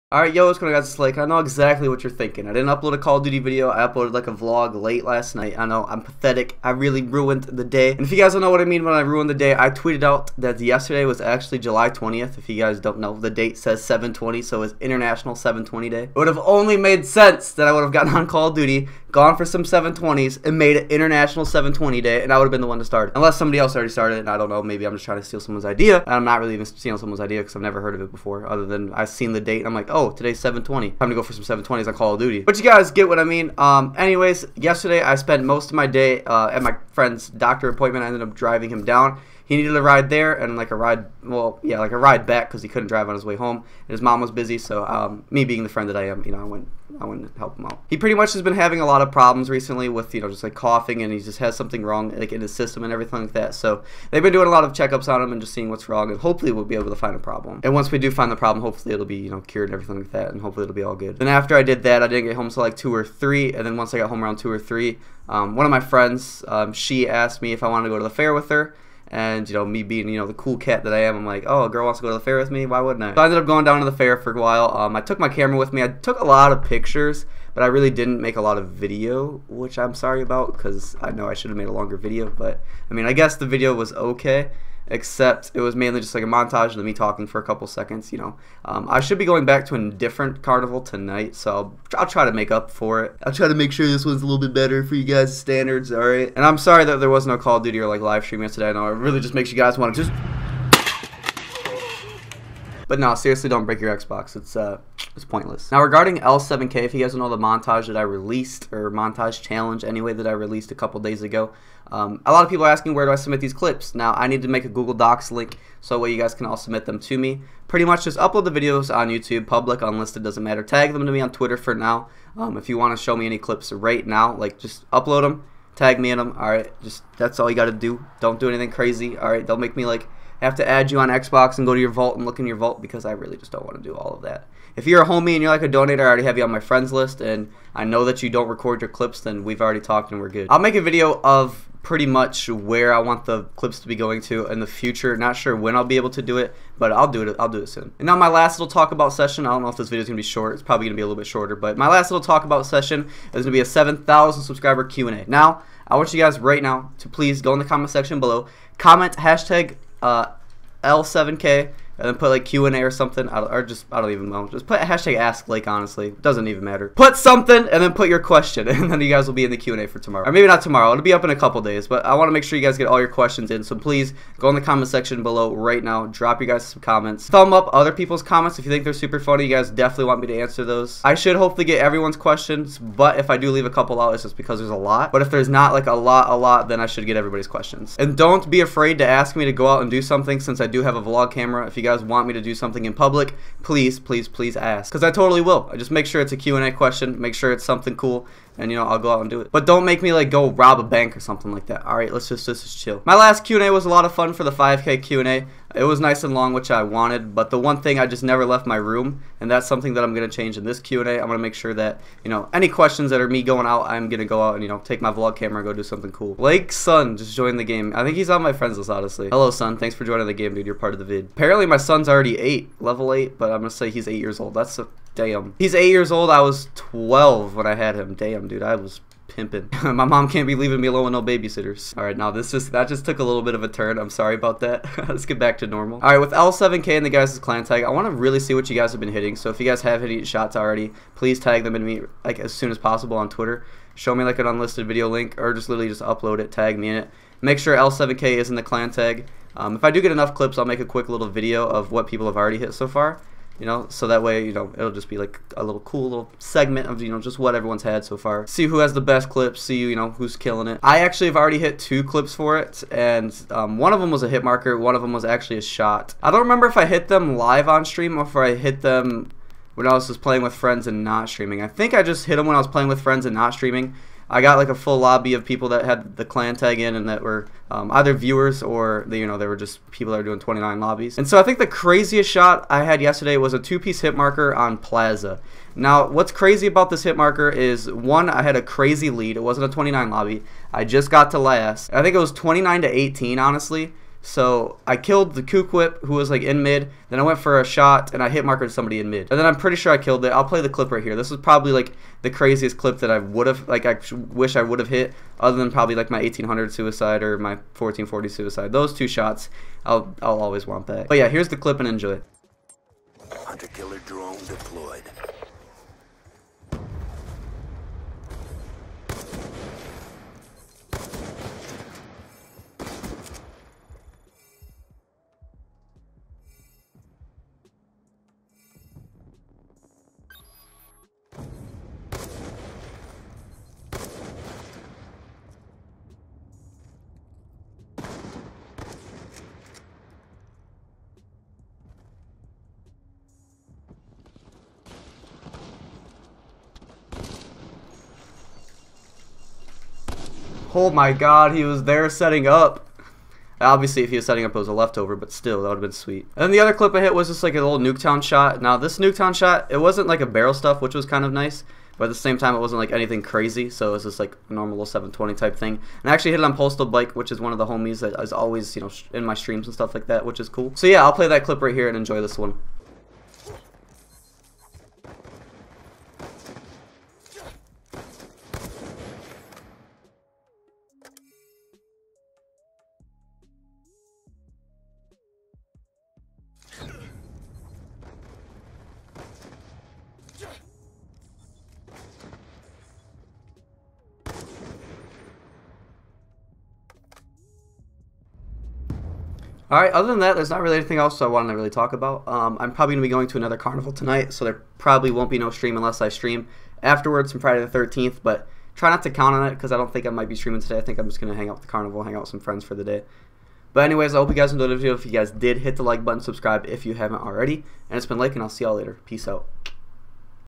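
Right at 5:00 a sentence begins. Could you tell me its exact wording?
I'll play the clip right here.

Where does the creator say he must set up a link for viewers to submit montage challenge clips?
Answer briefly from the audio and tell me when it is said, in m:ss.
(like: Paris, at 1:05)
Google Docs, at 1:54.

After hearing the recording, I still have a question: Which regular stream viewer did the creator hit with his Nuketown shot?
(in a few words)
Postal Bike.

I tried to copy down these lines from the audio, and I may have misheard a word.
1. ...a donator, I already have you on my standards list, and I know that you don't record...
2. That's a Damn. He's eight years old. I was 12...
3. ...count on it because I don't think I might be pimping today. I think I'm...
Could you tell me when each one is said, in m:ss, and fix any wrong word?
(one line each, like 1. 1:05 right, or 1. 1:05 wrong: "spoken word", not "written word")
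1. 2:15 wrong: "friends", not "standards"
2. 3:44 right
3. 6:49 wrong: "streaming", not "pimping".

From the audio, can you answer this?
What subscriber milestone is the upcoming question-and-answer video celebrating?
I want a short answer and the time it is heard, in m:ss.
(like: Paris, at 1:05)
7,000, at 2:33.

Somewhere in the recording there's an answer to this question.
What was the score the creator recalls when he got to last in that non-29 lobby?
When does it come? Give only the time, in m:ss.
4:52.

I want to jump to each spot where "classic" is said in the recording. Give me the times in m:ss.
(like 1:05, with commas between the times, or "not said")
not said.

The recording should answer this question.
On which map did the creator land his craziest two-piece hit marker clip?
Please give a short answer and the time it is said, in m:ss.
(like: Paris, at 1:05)
Plaza, at 4:44.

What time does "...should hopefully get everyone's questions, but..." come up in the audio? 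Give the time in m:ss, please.
3:01.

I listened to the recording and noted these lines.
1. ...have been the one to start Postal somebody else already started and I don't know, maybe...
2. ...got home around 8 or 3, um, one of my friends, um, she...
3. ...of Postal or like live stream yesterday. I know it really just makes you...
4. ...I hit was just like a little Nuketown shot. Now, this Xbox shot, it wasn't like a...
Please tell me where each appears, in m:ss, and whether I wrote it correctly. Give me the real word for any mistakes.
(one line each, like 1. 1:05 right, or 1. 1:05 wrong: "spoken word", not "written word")
1. 0:22 wrong: "Unless", not "Postal"
2. 1:03 wrong: "2", not "8"
3. 1:37 wrong: "Duty", not "Postal"
4. 5:56 wrong: "Nuketown", not "Xbox".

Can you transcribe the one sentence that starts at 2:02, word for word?
Um, if you want to show me any clips right now, like just upload them, tag me in them.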